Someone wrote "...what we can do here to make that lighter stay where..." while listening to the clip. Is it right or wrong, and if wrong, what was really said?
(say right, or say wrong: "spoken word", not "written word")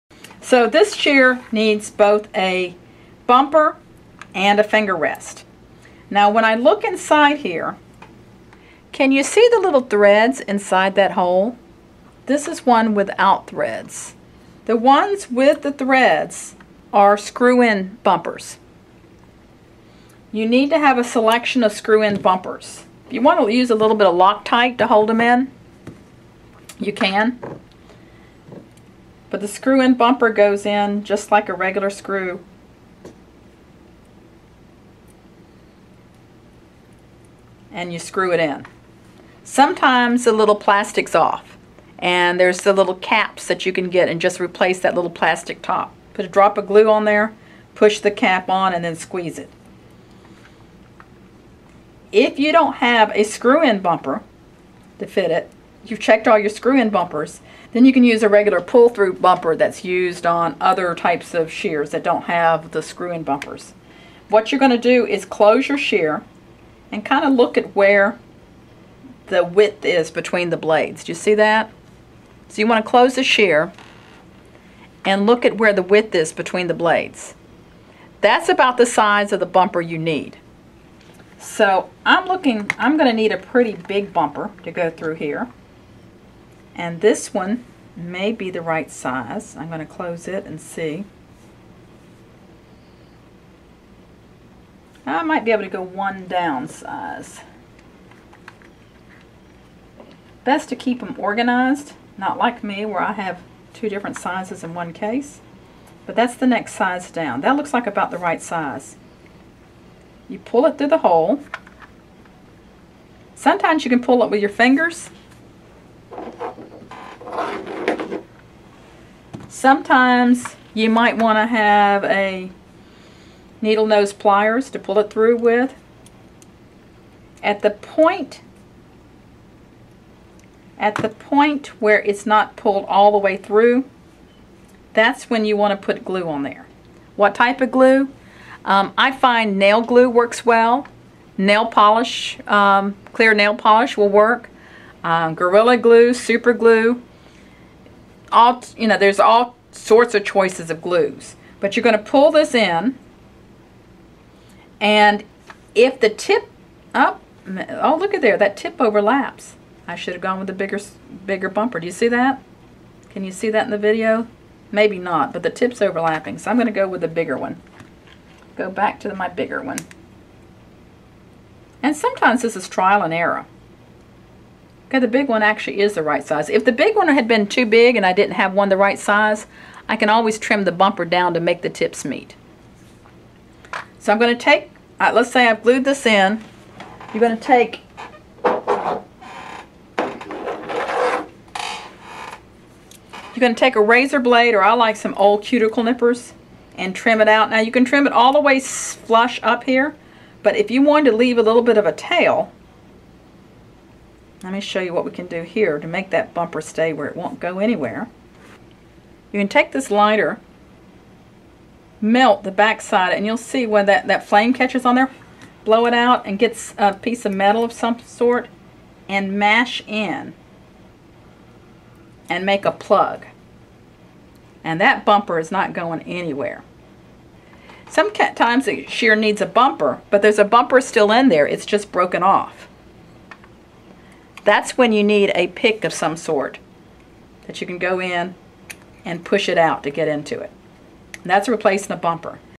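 wrong: "bumper", not "lighter".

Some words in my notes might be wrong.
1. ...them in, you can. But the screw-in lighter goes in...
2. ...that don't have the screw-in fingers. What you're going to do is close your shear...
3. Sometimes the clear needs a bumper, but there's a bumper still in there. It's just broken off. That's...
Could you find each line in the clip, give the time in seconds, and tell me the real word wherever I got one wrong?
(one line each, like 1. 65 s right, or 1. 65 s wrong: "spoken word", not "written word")
1. 25 s wrong: "bumper", not "lighter"
2. 61 s wrong: "bumpers", not "fingers"
3. 227 s wrong: "shear", not "clear".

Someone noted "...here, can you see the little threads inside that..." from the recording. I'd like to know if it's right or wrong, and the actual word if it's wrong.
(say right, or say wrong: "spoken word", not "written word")
right.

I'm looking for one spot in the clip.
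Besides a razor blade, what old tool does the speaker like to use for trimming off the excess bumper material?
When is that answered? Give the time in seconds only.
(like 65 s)
195 s.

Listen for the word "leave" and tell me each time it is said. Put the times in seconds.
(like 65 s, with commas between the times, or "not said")
201 s.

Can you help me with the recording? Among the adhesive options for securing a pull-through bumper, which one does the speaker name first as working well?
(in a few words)
nail glue.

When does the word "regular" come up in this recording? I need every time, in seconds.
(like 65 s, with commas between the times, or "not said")
31 s, 58 s.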